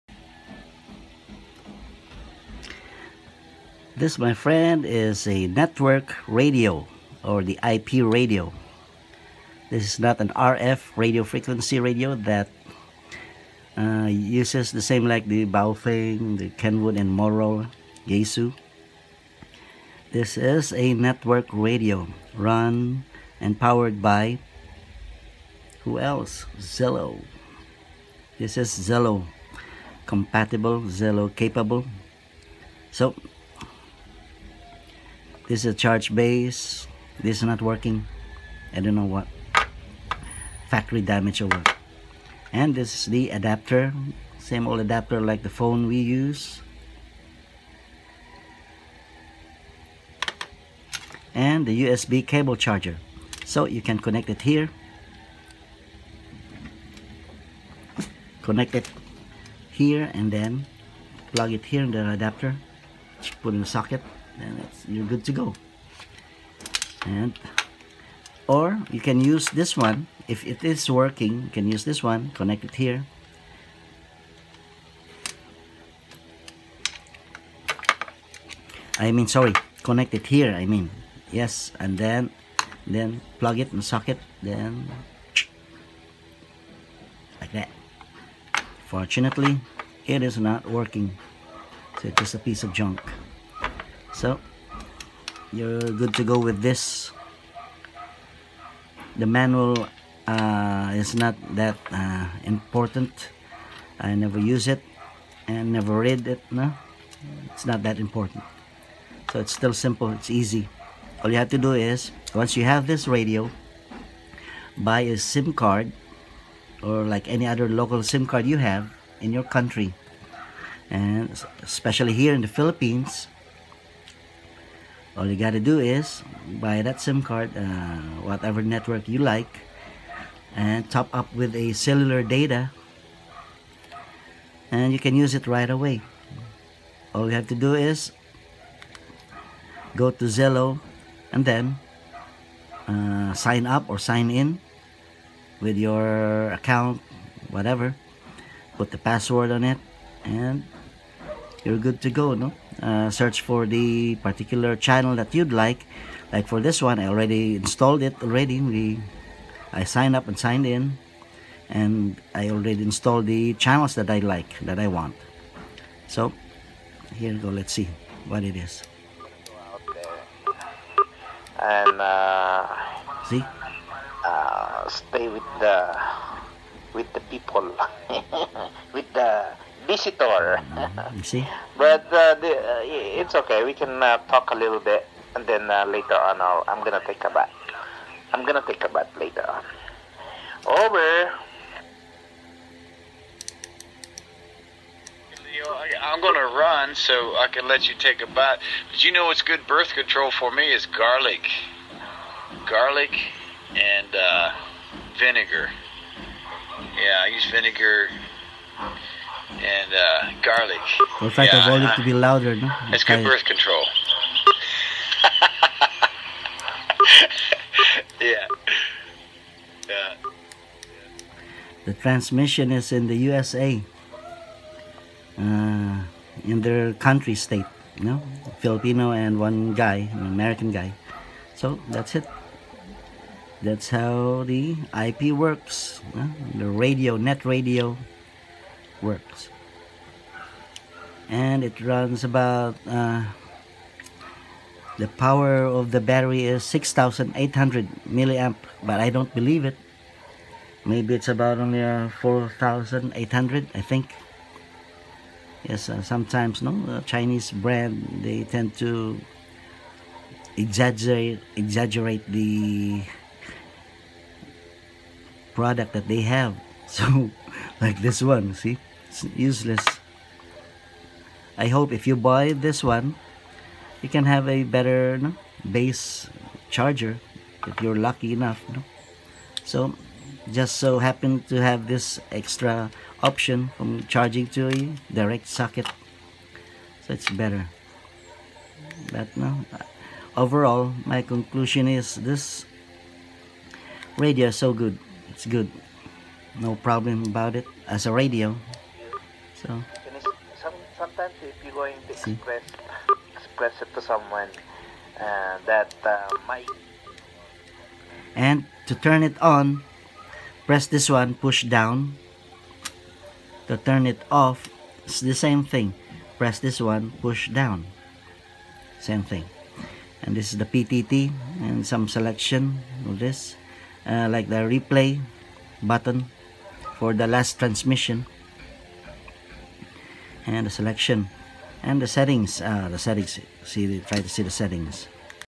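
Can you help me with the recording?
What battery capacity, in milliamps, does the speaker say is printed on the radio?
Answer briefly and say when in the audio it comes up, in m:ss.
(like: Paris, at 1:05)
6800, at 4:06.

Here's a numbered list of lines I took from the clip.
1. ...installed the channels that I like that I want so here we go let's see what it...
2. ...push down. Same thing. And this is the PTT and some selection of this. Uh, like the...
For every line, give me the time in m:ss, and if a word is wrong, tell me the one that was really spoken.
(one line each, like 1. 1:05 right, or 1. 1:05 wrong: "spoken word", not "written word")
1. 2:42 right
2. 5:17 right.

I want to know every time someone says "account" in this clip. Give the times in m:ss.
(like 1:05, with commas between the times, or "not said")
2:26.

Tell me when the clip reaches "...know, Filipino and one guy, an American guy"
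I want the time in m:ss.
3:48.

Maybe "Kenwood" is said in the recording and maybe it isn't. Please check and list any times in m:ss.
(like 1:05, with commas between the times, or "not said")
0:16.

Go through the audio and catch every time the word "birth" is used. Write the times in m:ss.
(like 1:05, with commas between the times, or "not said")
3:19, 3:33.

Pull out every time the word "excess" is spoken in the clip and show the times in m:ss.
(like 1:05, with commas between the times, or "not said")
not said.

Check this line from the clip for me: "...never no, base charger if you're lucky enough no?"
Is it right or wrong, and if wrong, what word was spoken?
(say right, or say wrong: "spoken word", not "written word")
wrong: "better", not "never".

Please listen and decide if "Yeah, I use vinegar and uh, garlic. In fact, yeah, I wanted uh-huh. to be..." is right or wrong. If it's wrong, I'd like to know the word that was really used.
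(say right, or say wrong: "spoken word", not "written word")
right.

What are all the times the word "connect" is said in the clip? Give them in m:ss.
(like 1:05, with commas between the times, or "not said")
0:53, 0:58, 1:12, 1:19.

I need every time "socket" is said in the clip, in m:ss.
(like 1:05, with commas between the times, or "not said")
1:03, 1:23, 4:45.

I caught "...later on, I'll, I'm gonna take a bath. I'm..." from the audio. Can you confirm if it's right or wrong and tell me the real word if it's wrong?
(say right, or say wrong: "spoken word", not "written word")
right.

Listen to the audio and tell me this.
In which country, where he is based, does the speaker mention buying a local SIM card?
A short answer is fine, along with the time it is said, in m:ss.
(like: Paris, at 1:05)
Philippines, at 2:02.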